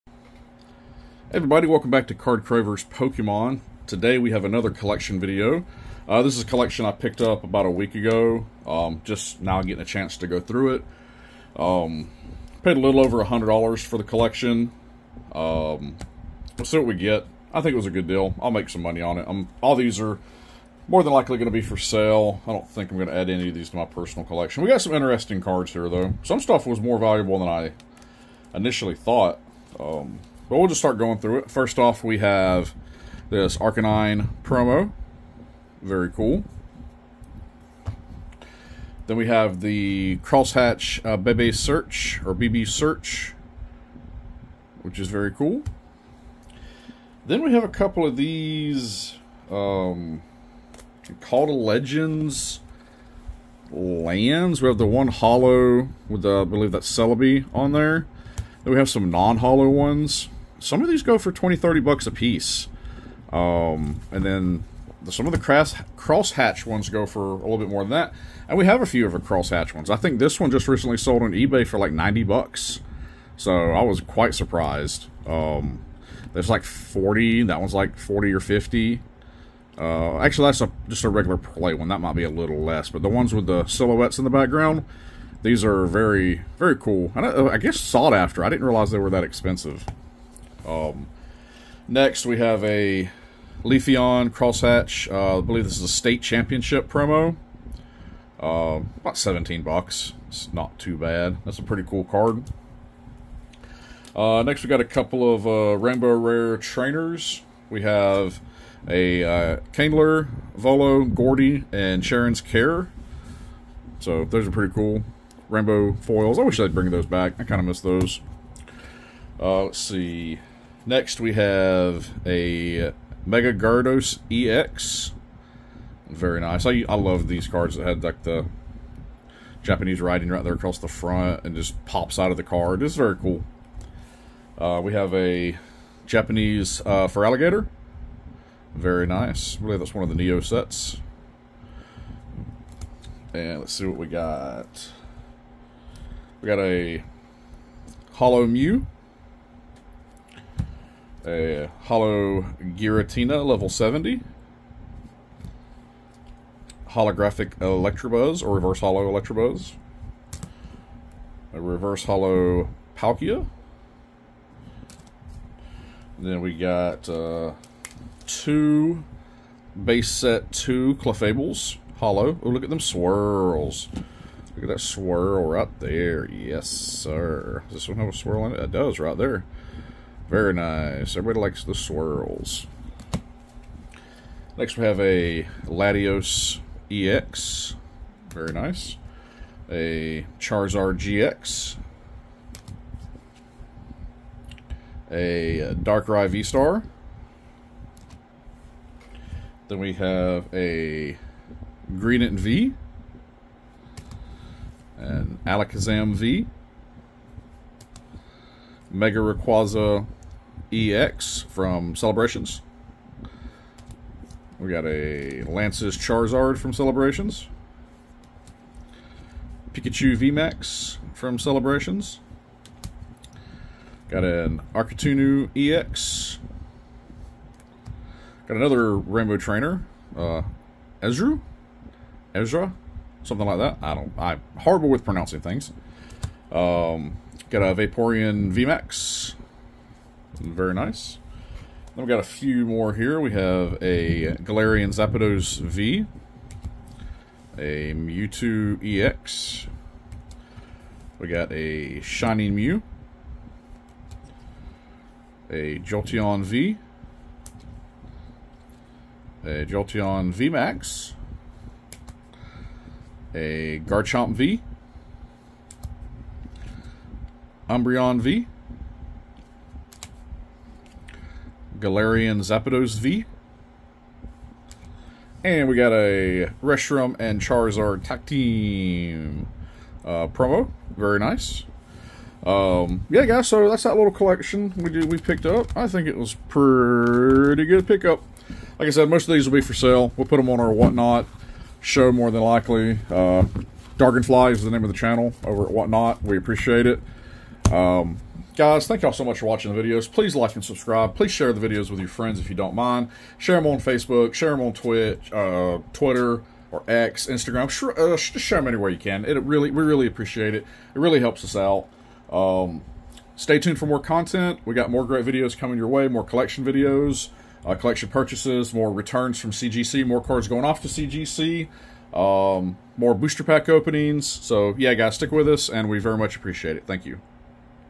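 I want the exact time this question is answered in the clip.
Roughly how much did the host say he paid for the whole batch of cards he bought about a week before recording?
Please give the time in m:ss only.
0:12.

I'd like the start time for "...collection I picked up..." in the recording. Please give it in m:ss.
0:06.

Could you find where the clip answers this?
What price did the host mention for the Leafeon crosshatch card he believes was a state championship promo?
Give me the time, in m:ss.
1:39.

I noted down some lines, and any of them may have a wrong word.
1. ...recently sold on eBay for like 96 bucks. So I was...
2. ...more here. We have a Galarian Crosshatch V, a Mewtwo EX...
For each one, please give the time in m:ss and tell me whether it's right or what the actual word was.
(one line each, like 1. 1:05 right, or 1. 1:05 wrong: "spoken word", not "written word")
1. 1:10 wrong: "90", not "96"
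2. 4:02 wrong: "Zapdos", not "Crosshatch".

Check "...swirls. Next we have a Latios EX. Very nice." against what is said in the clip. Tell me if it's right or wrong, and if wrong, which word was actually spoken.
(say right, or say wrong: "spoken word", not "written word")
right.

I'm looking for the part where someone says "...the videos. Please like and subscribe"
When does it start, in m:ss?
4:59.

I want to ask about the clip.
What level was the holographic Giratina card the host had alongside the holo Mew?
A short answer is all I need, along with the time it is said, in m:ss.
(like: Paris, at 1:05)
70, at 2:33.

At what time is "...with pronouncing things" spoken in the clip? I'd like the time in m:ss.
3:54.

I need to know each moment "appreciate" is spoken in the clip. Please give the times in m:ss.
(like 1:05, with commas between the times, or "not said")
4:56, 5:10, 5:26.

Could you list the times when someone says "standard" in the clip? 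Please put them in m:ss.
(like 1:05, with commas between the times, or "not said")
not said.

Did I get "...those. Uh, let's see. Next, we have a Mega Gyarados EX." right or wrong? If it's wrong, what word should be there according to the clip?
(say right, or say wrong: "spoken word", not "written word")
right.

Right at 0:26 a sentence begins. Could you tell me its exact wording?
Some stuff was more valuable than I initially thought.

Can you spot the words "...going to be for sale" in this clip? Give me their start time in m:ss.
0:21.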